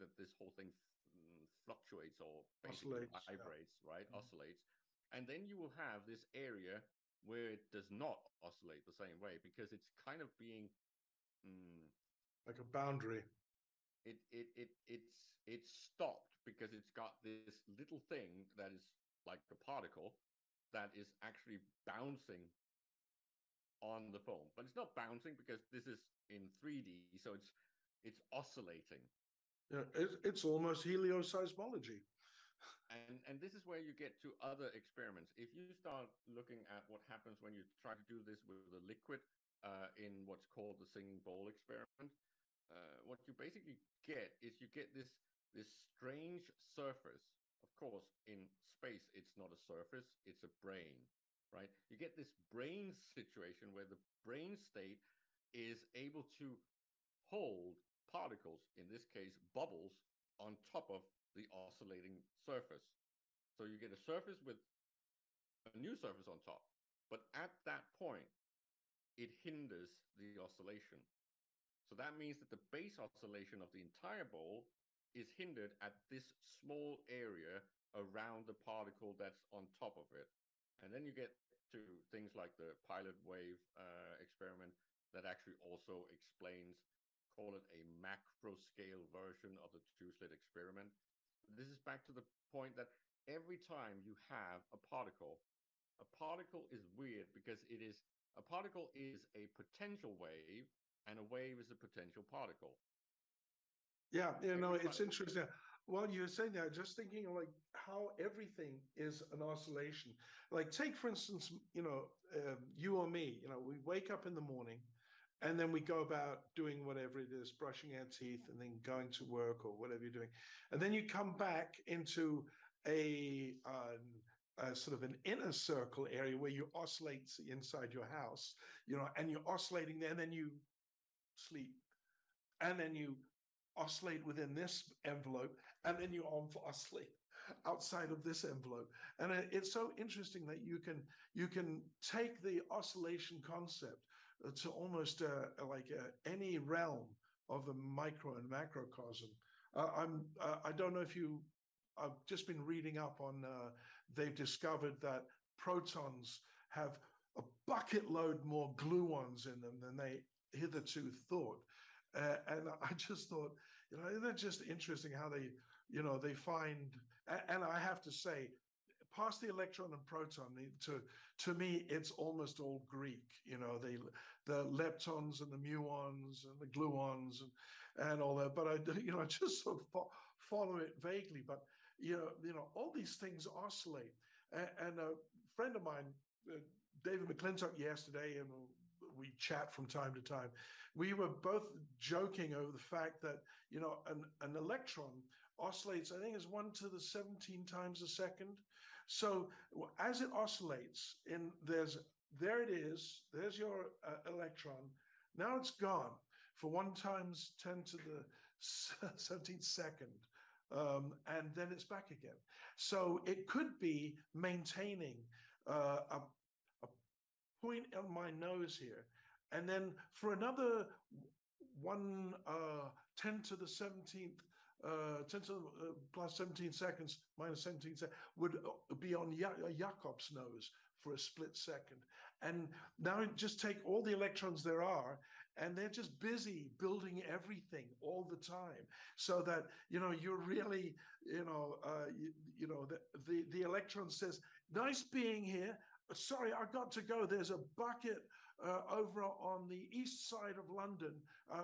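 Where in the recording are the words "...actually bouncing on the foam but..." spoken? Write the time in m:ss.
0:21.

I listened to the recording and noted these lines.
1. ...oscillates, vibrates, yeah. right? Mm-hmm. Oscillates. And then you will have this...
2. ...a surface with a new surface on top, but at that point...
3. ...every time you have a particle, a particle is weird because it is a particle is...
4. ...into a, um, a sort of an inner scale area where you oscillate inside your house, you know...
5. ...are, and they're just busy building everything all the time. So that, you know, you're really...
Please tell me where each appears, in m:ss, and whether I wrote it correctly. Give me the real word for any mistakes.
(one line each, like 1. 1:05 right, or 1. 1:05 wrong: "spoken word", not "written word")
1. 0:03 right
2. 1:03 right
3. 1:33 right
4. 2:01 wrong: "circle", not "scale"
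5. 3:54 right.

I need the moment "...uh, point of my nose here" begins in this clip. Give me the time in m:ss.
3:35.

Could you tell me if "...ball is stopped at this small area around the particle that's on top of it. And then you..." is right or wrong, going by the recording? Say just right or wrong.
wrong.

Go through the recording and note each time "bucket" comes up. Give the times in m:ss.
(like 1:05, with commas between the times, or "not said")
2:37, 4:07.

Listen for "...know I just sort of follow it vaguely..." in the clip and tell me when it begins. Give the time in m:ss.
2:59.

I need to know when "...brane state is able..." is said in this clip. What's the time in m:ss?
0:54.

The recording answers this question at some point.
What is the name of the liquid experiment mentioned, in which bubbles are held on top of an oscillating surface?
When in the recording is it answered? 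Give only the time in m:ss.
0:40.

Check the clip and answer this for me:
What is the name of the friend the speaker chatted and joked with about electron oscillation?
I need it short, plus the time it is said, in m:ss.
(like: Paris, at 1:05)
David McClintock, at 3:06.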